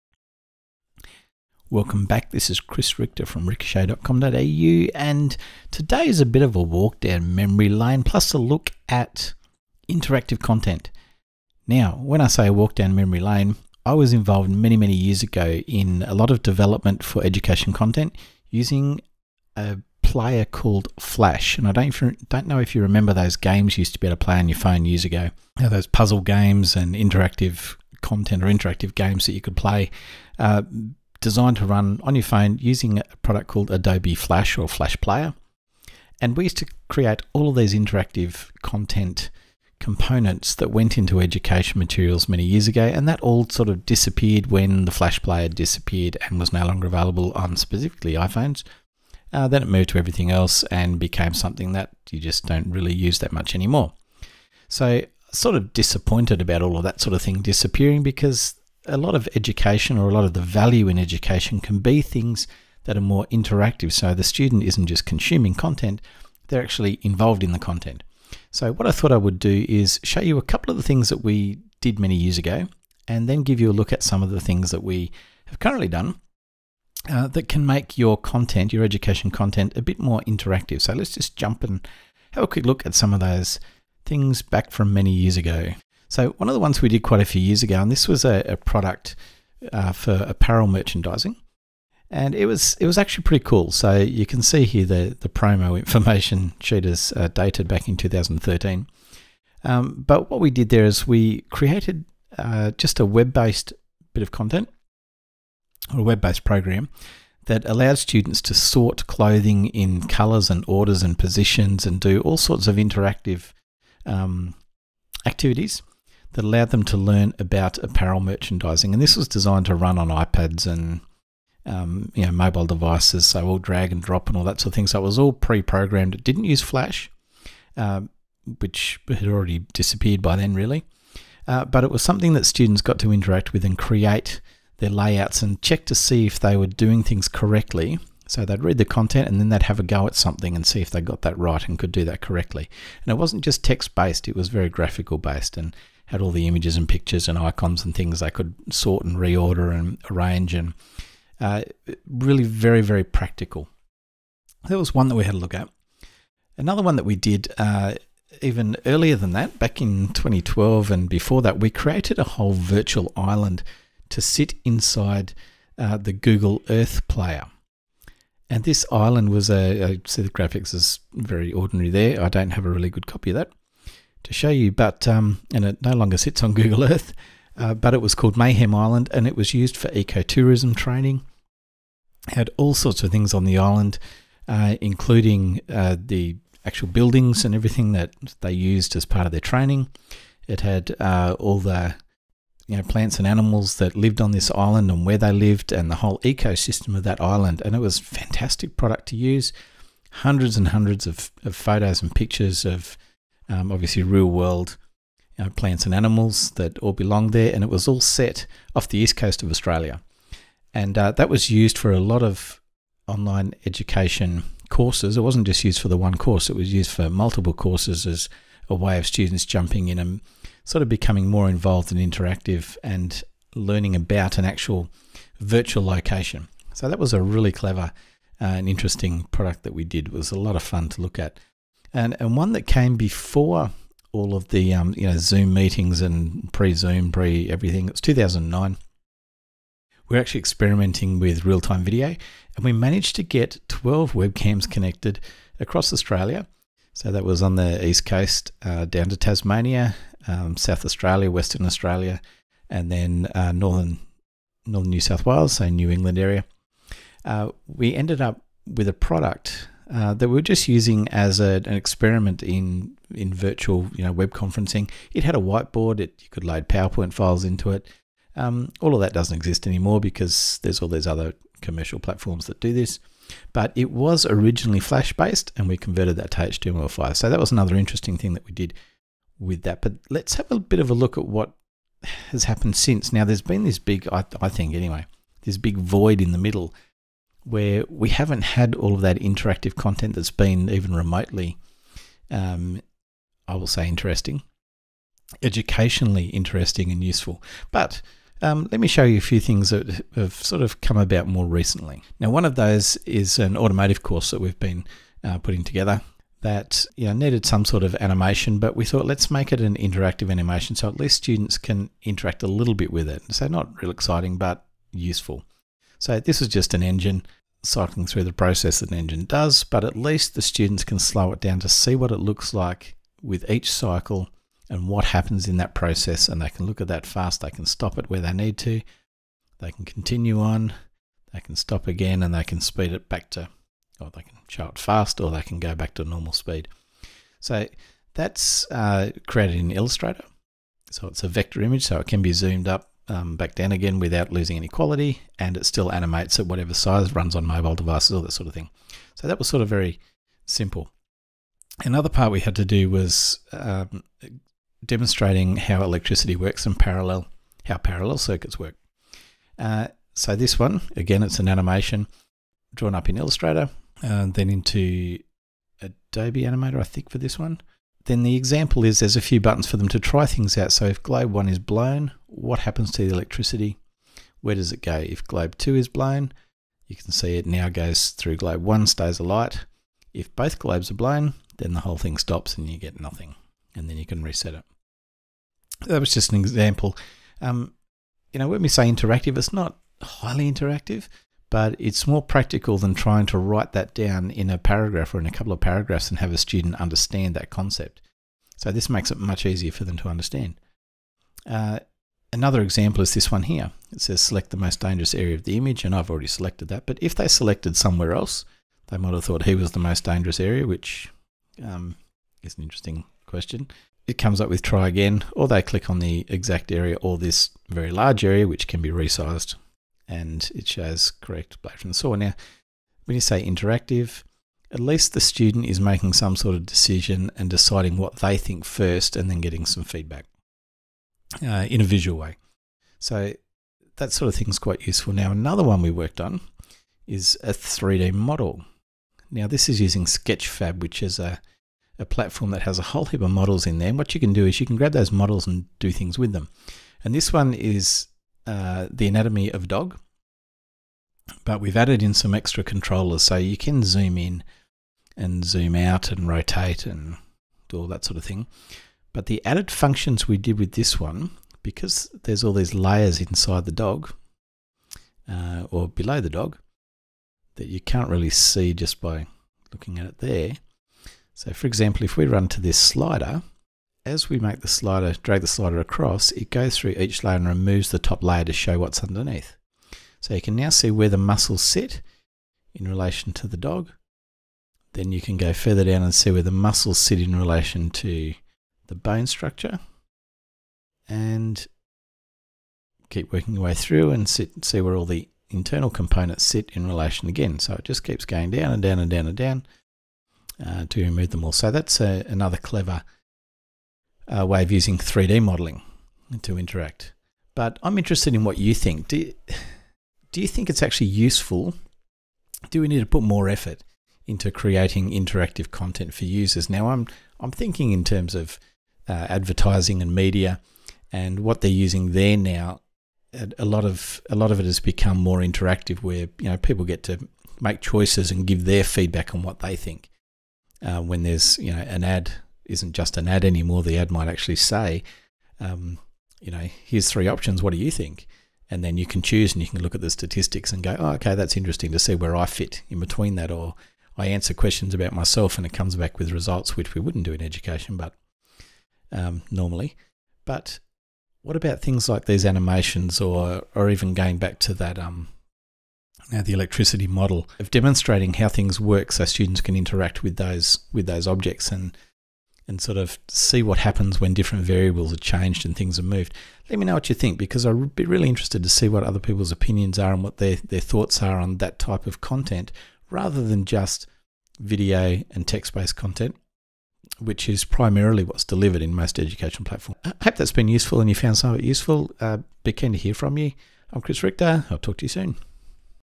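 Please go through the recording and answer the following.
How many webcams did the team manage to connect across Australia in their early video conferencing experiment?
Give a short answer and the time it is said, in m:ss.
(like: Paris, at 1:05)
12, at 4:03.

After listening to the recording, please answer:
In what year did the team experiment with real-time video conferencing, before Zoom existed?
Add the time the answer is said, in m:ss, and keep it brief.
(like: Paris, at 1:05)
2009, at 3:58.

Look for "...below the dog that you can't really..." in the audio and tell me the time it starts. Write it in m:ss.
7:45.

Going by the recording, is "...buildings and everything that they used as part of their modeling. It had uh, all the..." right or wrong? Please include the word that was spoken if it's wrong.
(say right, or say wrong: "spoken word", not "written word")
wrong: "training", not "modeling".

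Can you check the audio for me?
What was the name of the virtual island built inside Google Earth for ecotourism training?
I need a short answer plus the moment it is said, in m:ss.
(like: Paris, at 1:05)
Mayhem Island, at 2:58.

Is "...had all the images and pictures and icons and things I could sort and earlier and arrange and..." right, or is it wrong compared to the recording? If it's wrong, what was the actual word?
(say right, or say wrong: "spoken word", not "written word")
wrong: "reorder", not "earlier".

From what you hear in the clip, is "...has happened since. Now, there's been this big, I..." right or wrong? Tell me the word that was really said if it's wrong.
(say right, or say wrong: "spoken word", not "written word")
right.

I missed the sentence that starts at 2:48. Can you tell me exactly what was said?
And this island was a, I see the graphics is very ordinary there.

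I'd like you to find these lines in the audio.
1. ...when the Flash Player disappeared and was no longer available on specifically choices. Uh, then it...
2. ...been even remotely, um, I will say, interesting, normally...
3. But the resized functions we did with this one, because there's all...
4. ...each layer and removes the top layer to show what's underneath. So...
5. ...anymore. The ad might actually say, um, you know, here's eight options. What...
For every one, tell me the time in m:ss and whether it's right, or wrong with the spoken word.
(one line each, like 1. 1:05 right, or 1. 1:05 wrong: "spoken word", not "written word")
1. 0:44 wrong: "iPhones", not "choices"
2. 4:50 wrong: "educationally", not "normally"
3. 7:39 wrong: "added", not "resized"
4. 7:56 right
5. 8:53 wrong: "three", not "eight".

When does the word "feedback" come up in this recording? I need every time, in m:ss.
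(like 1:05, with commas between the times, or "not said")
7:09, 8:48.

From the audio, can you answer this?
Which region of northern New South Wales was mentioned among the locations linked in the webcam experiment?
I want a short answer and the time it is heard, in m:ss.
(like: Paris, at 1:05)
New England, at 4:15.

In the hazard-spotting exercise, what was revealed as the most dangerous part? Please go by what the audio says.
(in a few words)
Blade from the saw.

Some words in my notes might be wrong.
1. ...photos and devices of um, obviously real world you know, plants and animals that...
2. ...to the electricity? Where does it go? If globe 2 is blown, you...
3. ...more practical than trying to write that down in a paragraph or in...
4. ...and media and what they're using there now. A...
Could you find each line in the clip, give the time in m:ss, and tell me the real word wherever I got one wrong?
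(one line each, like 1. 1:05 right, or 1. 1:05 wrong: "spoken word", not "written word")
1. 3:21 wrong: "pictures", not "devices"
2. 6:12 right
3. 6:32 right
4. 8:40 right.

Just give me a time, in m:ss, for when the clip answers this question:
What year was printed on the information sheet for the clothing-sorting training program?
1:37.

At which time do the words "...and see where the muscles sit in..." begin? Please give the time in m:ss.
8:06.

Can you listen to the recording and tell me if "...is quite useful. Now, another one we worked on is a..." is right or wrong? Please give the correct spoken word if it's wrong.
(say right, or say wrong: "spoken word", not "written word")
right.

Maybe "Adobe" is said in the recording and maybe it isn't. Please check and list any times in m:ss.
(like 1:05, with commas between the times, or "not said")
0:33, 6:05.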